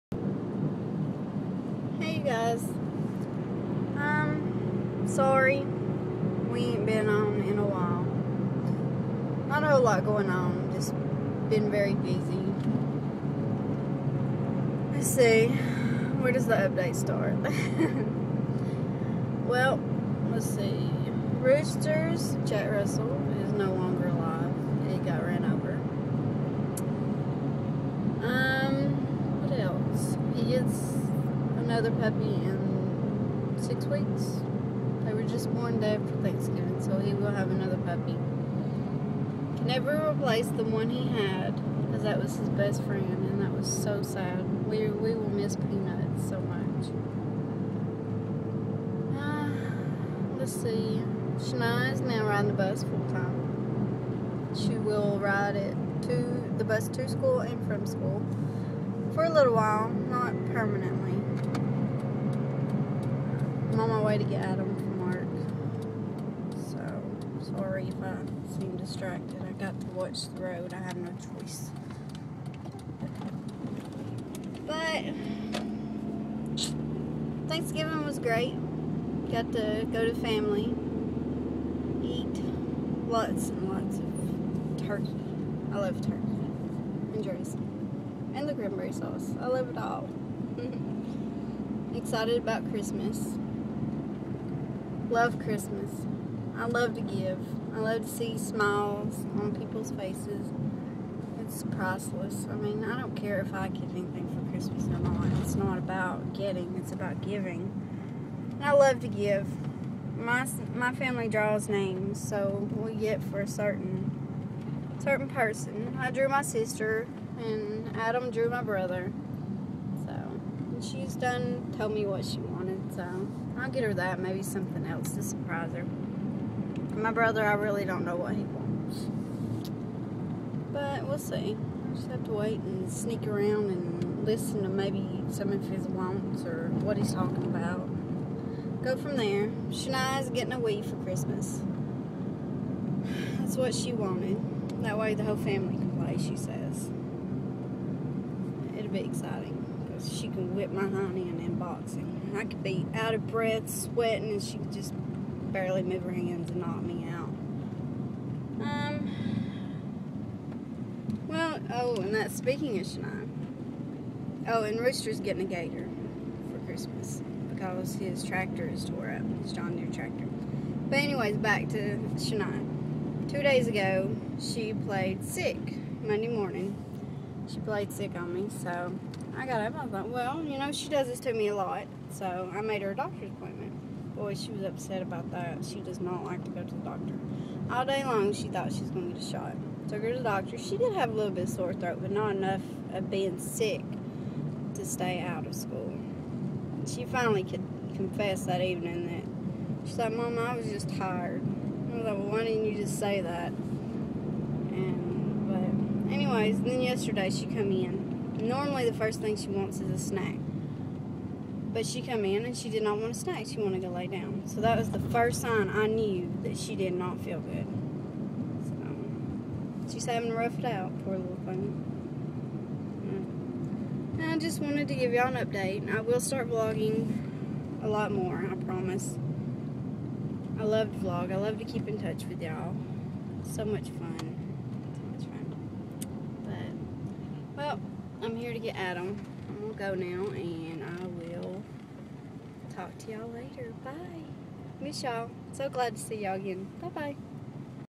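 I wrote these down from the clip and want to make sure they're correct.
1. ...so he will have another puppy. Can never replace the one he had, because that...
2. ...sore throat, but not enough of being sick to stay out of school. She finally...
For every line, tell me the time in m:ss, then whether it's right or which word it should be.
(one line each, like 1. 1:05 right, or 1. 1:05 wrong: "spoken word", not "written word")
1. 0:36 right
2. 3:11 right.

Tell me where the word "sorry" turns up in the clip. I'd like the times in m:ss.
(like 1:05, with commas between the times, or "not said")
0:05, 1:07.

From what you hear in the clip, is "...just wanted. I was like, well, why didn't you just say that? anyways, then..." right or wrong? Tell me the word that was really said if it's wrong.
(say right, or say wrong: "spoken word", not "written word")
wrong: "tired", not "wanted".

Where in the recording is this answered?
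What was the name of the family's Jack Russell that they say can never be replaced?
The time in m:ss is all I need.
0:45.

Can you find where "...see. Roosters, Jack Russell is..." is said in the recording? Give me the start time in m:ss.
0:20.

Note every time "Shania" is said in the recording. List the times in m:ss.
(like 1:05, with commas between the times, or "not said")
0:51, 2:19, 2:42, 2:52.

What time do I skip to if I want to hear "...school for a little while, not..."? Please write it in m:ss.
0:57.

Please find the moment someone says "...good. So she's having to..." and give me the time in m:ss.
3:37.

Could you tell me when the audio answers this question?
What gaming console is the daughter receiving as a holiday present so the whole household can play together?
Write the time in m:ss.
2:20.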